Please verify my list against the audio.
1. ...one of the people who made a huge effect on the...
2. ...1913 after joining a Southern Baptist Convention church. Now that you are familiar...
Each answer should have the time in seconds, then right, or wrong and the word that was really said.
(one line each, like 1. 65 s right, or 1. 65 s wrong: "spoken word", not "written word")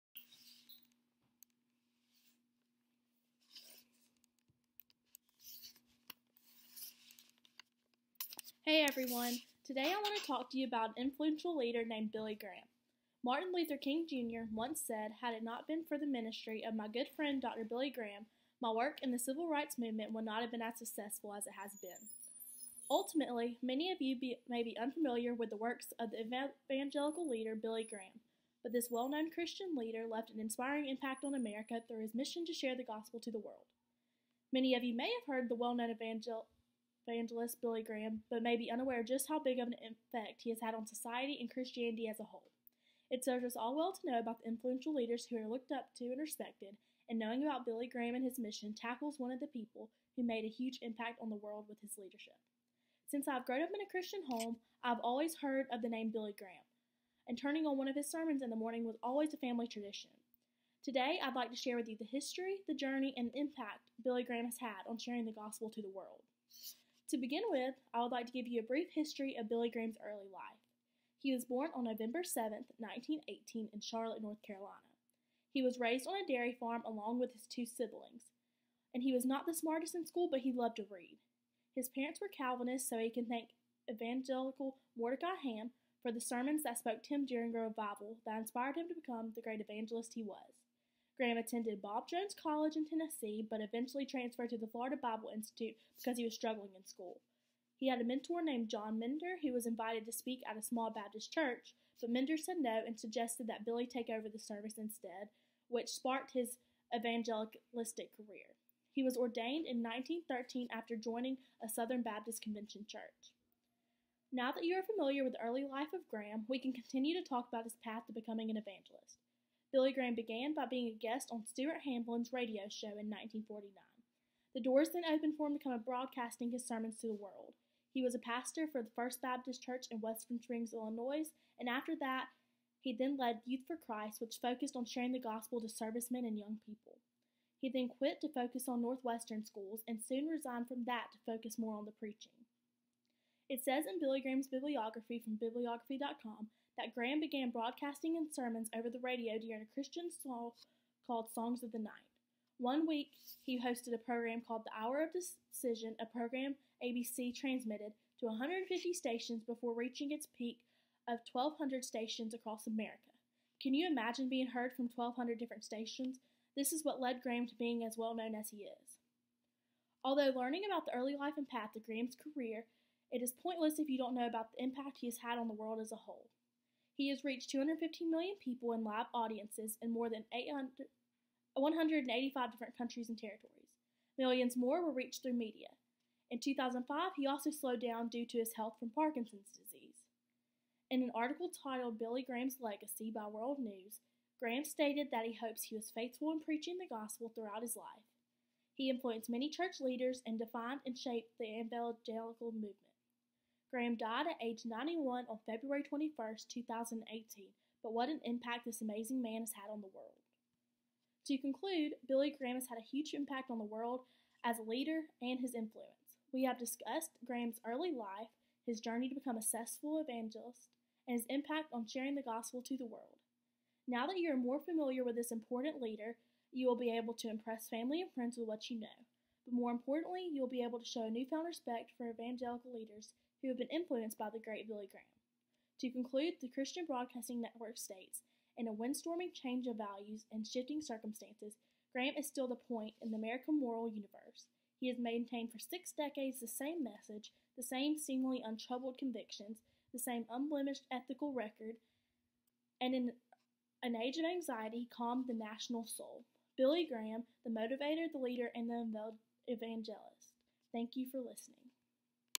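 1. 49 s wrong: "impact", not "effect"
2. 109 s right.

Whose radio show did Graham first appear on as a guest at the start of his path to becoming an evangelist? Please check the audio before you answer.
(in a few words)
Stuart Hamblen.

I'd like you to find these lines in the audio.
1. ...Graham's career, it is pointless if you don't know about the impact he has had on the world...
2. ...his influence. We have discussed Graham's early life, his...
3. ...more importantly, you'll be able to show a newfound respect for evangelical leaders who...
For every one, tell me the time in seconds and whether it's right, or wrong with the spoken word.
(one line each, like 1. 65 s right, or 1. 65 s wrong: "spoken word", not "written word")
1. 171 s right
2. 215 s right
3. 229 s right.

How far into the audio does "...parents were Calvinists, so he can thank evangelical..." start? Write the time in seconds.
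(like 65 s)
81 s.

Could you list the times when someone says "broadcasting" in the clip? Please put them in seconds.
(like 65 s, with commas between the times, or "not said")
125 s, 147 s, 236 s.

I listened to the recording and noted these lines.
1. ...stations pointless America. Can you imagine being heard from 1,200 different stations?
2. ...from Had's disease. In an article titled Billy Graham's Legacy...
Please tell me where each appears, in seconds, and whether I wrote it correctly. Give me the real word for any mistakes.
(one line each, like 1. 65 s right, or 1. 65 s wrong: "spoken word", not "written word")
1. 161 s wrong: "across", not "pointless"
2. 188 s wrong: "Parkinson", not "Had".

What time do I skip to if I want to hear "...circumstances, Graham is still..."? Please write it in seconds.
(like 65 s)
240 s.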